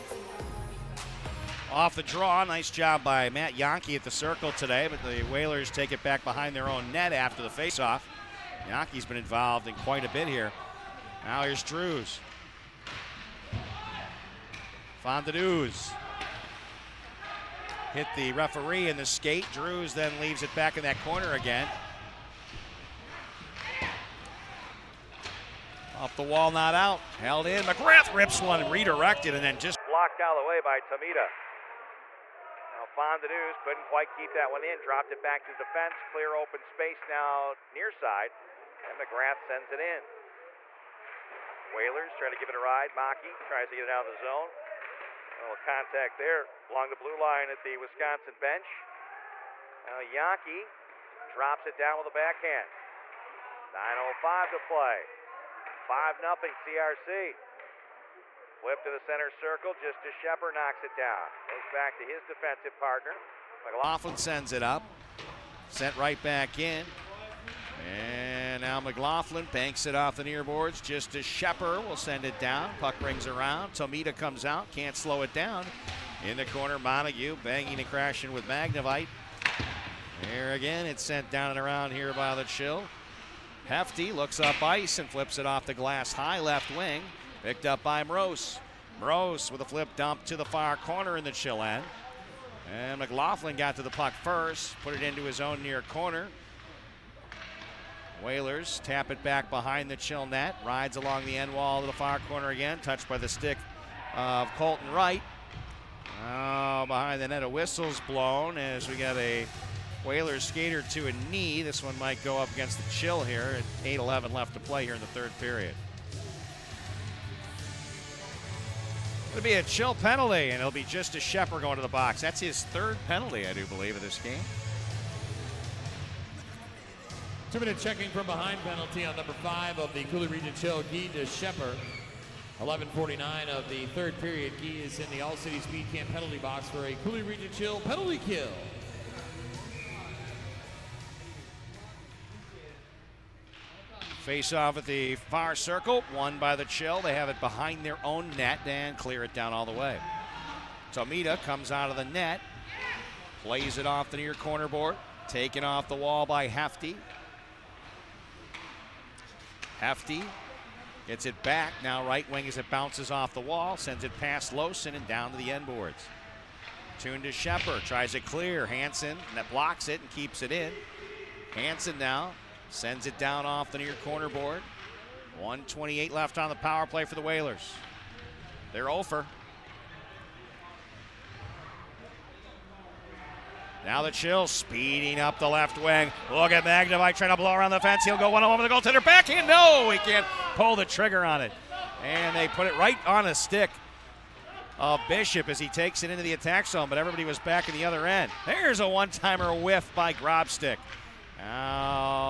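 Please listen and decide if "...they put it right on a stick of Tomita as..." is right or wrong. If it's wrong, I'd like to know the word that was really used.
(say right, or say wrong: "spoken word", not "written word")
wrong: "Bishop", not "Tomita".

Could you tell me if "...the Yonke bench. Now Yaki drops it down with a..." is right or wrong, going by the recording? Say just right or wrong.
wrong.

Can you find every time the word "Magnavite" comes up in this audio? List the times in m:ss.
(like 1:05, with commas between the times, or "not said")
1:18, 3:06.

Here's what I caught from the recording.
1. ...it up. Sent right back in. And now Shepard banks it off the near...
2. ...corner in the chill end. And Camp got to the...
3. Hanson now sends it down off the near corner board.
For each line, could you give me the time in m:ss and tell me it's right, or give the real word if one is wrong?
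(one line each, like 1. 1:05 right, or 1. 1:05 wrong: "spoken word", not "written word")
1. 1:04 wrong: "McLaughlin", not "Shepard"
2. 1:30 wrong: "McLaughlin", not "Camp"
3. 2:51 right.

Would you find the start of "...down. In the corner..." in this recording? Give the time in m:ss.
1:15.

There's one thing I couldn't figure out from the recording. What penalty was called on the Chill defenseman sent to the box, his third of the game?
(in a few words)
Checking from behind.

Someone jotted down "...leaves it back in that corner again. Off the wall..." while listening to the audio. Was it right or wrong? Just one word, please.
right.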